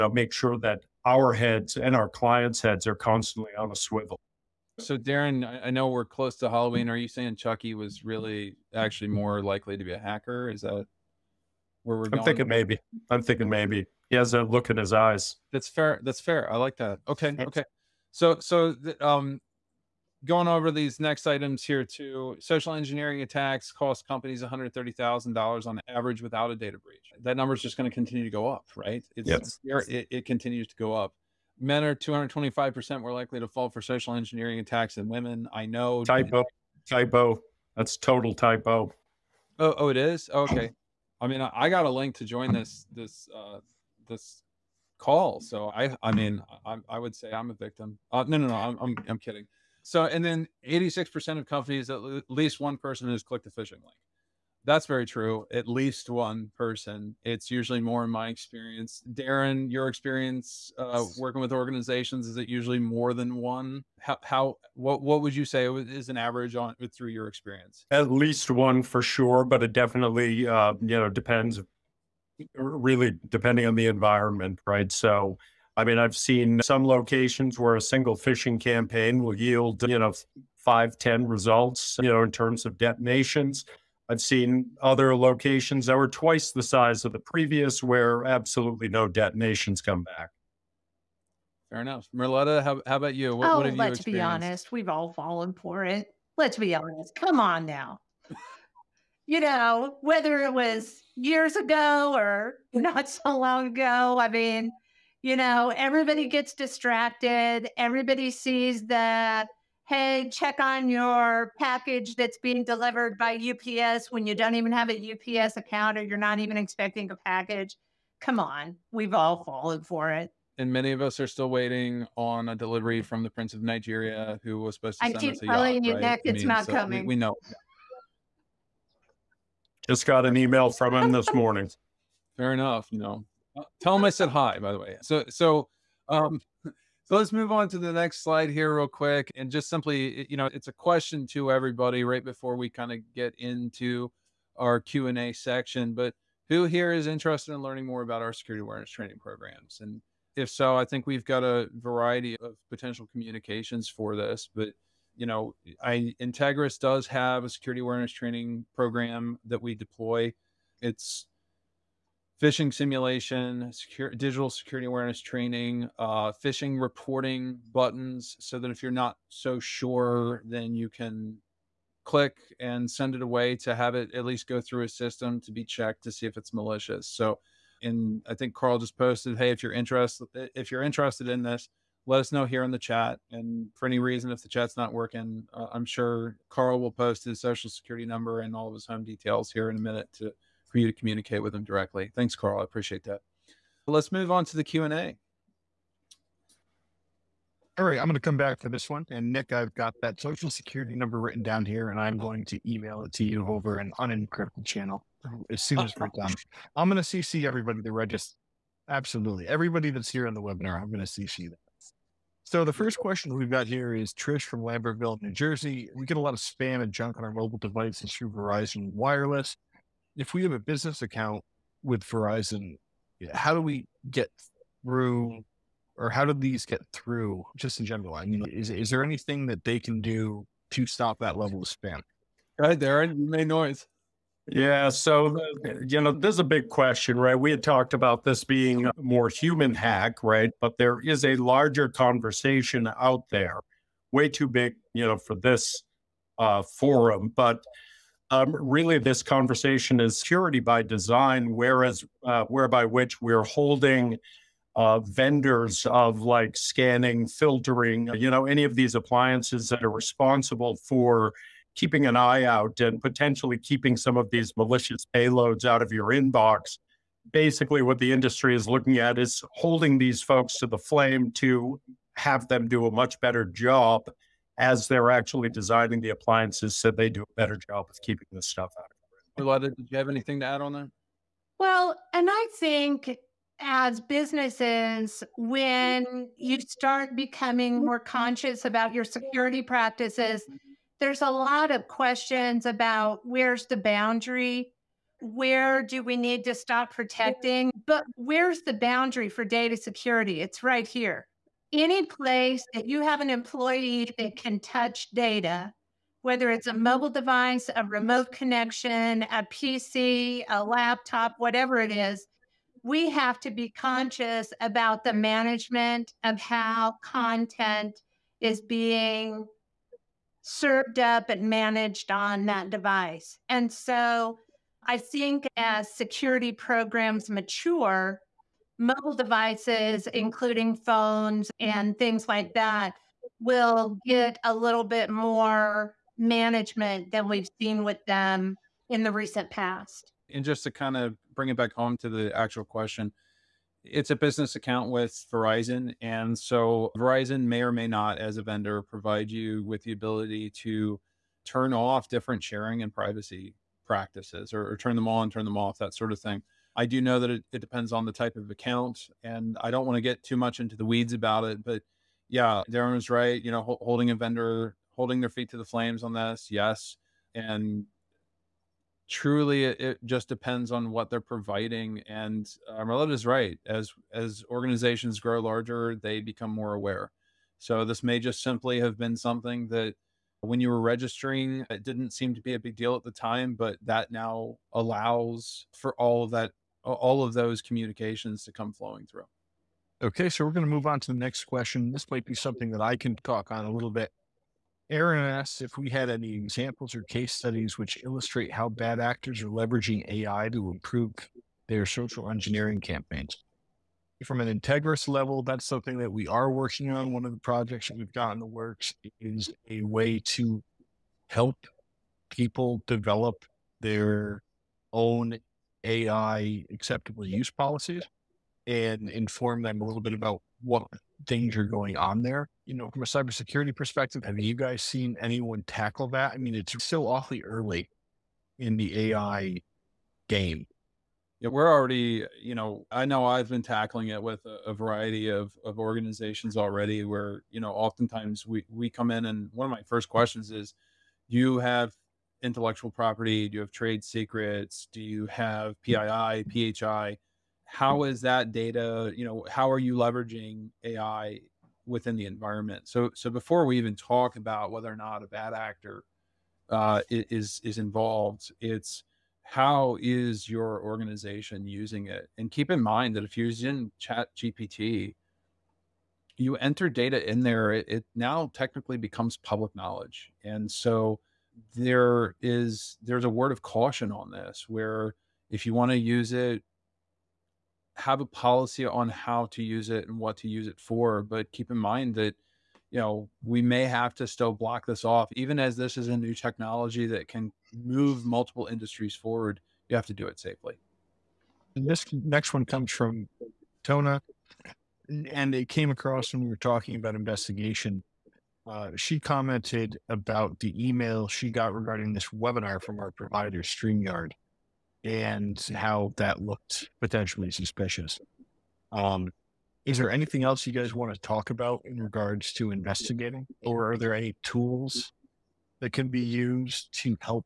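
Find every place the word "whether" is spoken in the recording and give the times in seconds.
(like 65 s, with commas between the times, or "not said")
100 s, 306 s, 454 s.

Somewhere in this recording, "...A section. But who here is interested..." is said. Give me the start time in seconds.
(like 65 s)
145 s.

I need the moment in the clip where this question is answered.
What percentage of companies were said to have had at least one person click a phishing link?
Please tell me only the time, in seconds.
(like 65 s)
50 s.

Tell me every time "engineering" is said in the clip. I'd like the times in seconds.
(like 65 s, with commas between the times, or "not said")
22 s, 34 s, 402 s.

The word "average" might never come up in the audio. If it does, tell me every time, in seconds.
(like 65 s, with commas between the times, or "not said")
25 s, 66 s.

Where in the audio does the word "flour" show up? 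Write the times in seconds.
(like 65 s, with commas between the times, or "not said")
not said.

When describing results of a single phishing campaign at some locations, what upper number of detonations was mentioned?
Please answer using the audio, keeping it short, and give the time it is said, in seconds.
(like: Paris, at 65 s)
10, at 80 s.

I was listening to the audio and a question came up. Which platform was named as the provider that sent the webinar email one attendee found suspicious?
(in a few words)
StreamYard.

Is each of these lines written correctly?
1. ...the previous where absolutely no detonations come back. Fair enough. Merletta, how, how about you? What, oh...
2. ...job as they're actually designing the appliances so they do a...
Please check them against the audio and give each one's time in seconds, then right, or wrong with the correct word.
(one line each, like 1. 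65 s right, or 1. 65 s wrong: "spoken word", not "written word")
1. 87 s right
2. 273 s right.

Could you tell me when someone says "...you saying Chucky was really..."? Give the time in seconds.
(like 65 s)
6 s.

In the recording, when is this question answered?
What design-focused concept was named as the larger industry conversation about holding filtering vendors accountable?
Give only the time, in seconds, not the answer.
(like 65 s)
250 s.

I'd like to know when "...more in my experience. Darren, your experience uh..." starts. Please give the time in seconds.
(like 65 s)
57 s.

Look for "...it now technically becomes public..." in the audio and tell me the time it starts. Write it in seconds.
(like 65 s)
467 s.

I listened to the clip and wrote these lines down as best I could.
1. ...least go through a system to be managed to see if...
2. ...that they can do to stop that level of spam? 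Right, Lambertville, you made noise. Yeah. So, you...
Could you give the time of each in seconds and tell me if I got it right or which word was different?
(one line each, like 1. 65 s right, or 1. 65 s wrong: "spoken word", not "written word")
1. 174 s wrong: "checked", not "managed"
2. 229 s wrong: "Darren", not "Lambertville".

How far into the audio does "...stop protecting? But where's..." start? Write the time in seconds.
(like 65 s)
296 s.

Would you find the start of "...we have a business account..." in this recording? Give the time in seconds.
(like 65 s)
220 s.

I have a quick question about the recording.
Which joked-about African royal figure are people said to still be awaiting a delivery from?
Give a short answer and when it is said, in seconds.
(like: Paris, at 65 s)
Prince of Nigeria, at 123 s.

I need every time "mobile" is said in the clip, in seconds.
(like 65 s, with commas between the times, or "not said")
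217 s, 306 s, 328 s.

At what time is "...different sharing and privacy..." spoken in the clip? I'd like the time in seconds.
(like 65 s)
352 s.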